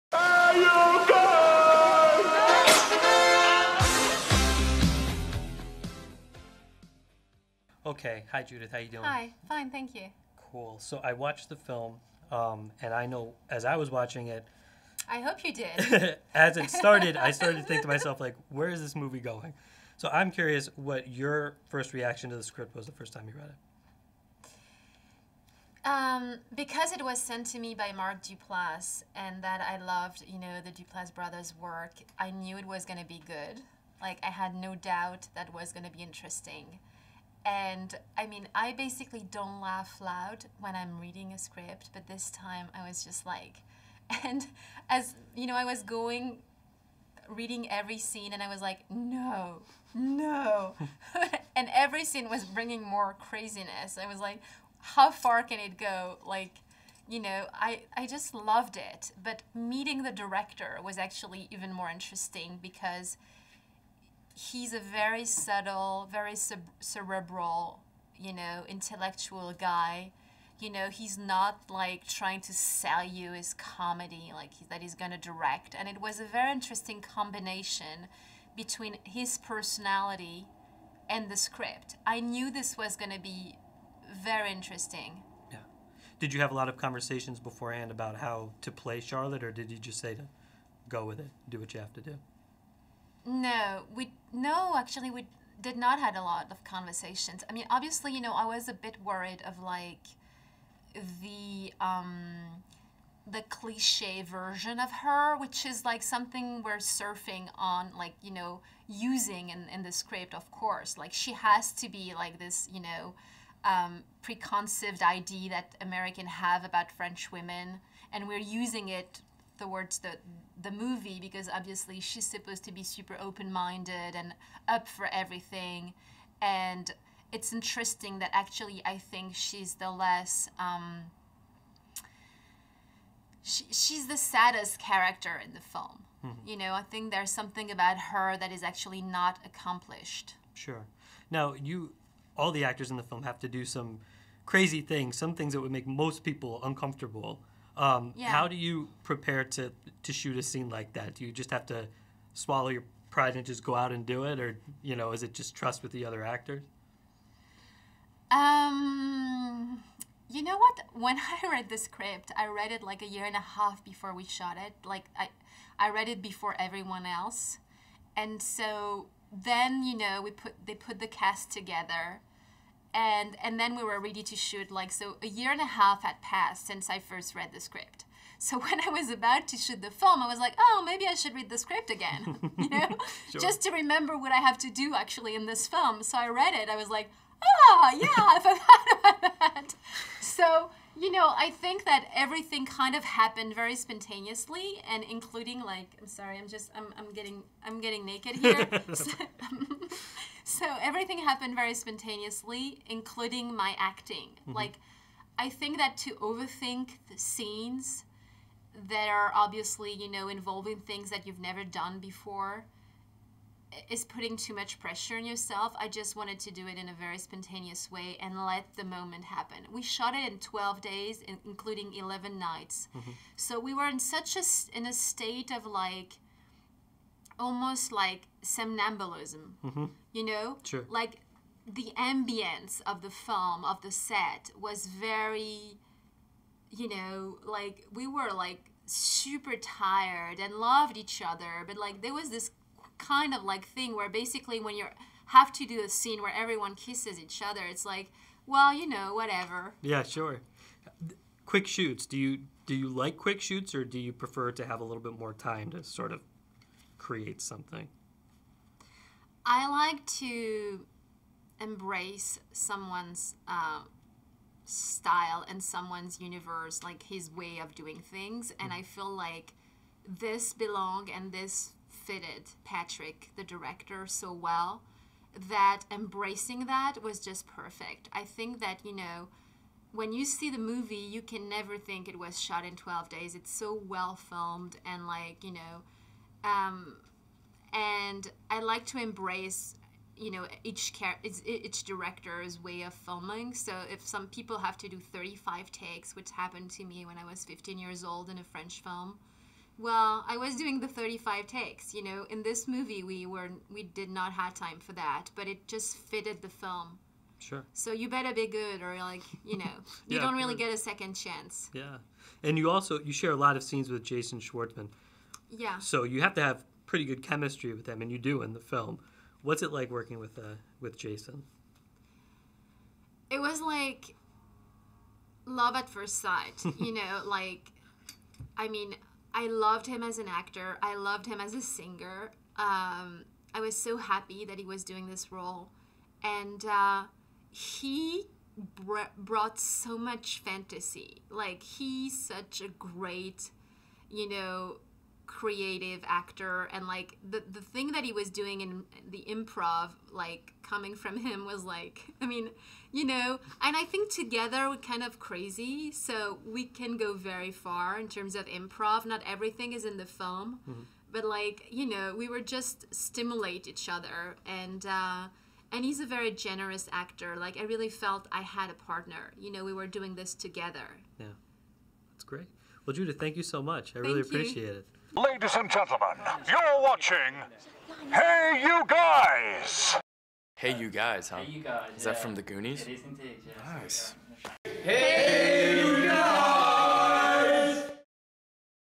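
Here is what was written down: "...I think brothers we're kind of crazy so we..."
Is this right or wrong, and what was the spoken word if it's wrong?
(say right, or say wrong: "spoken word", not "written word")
wrong: "together", not "brothers".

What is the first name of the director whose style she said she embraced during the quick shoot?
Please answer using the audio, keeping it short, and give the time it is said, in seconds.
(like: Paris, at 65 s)
Patrick, at 272 s.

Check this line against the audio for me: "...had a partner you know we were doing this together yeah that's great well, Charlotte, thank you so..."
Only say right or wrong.
wrong.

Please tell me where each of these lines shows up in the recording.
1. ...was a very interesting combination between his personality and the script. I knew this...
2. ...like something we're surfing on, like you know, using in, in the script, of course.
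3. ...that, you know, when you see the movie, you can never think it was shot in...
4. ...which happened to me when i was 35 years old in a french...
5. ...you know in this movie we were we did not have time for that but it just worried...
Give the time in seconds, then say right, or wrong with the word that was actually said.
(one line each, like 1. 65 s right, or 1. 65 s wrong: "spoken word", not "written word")
1. 75 s right
2. 105 s right
3. 278 s right
4. 296 s wrong: "15", not "35"
5. 301 s wrong: "fitted", not "worried".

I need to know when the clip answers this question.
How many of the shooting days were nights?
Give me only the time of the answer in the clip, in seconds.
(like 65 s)
221 s.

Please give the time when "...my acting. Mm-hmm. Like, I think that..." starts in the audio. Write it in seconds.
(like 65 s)
203 s.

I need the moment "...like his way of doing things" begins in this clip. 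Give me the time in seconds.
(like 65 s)
266 s.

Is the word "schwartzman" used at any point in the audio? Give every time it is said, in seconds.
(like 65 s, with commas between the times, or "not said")
314 s.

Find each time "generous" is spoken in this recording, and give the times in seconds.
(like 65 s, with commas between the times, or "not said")
366 s.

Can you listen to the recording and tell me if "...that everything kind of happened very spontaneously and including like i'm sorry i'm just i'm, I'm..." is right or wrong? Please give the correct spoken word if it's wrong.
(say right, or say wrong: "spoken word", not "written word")
right.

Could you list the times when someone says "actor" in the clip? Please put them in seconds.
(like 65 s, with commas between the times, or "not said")
142 s, 156 s, 330 s, 346 s, 366 s.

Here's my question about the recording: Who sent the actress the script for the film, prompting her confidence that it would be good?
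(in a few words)
Mark Duplass.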